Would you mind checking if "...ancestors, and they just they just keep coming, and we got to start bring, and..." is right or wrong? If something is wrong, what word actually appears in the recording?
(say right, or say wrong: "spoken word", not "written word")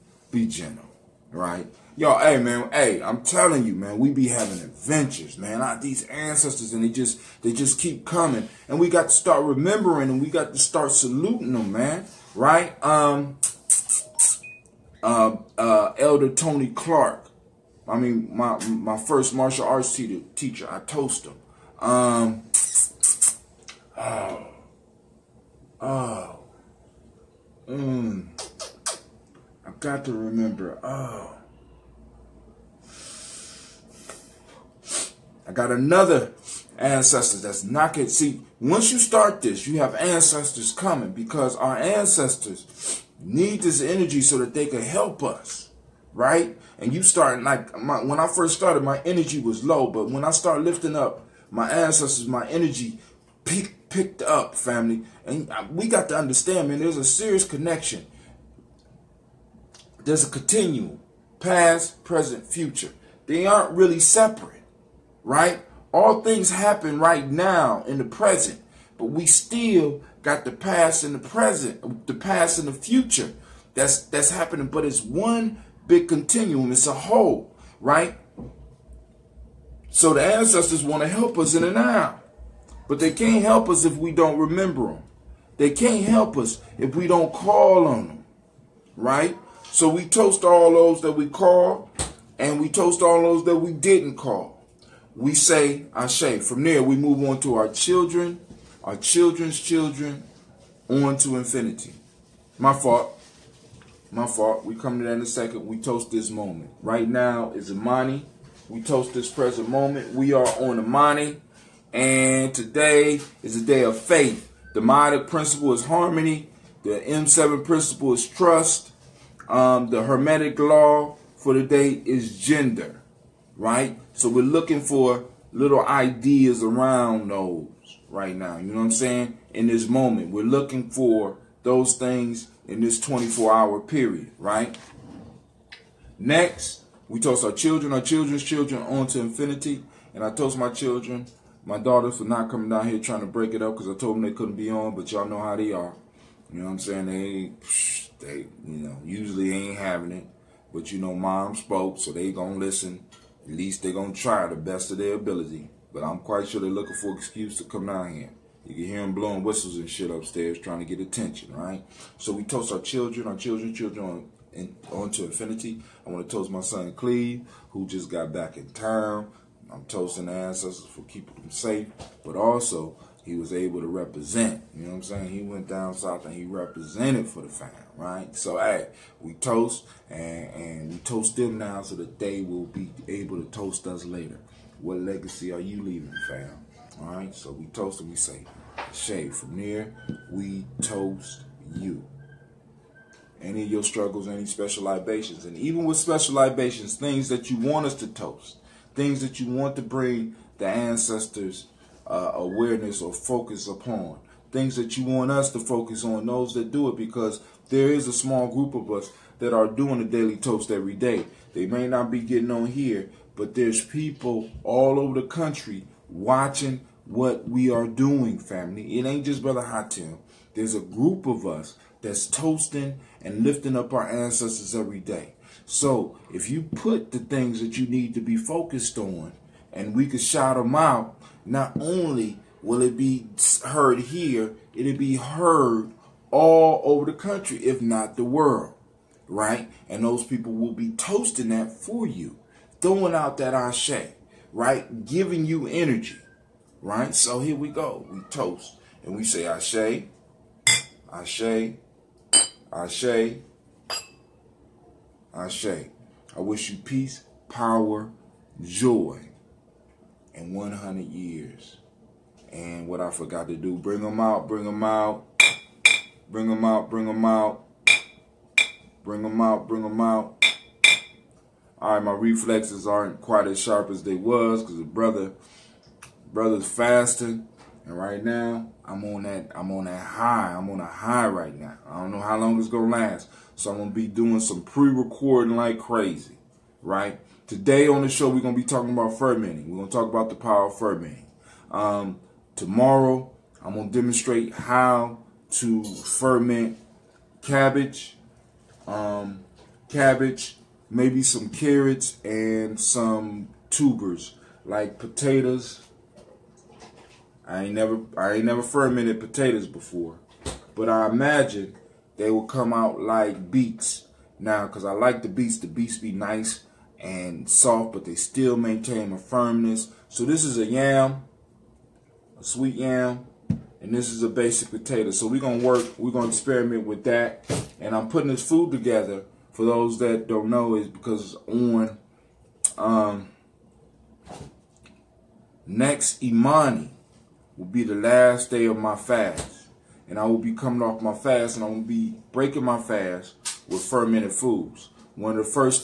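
wrong: "remembering", not "bring".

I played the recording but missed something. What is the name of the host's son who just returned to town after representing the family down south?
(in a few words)
Cleve.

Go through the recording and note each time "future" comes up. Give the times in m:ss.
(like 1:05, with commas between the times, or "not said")
1:02, 1:12.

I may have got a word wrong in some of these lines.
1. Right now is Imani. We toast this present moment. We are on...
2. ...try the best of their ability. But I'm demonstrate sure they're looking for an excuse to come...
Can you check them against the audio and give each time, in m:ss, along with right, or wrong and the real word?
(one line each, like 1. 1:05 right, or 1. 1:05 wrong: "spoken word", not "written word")
1. 1:46 right
2. 2:34 wrong: "quite", not "demonstrate".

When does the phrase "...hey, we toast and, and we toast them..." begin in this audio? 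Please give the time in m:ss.
2:58.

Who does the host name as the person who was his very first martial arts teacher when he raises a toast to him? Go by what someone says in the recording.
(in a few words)
Elder Tony Clark.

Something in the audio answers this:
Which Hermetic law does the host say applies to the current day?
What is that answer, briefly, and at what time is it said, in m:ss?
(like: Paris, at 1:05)
gender, at 2:02.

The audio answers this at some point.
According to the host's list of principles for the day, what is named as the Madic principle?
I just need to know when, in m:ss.
1:55.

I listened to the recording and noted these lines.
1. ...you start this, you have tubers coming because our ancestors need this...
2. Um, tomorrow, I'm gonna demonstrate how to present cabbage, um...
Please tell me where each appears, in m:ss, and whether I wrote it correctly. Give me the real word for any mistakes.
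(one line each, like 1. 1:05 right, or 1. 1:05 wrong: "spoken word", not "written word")
1. 0:38 wrong: "ancestors", not "tubers"
2. 4:51 wrong: "ferment", not "present".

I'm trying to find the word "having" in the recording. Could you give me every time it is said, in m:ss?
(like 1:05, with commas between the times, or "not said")
0:04, 2:29.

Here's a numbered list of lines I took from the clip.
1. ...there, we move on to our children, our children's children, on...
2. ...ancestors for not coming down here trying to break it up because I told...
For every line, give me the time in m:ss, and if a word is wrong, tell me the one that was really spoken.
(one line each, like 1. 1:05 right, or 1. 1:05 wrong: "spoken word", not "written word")
1. 1:36 right
2. 2:21 wrong: "daughters", not "ancestors".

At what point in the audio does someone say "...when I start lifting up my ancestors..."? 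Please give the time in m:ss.
0:50.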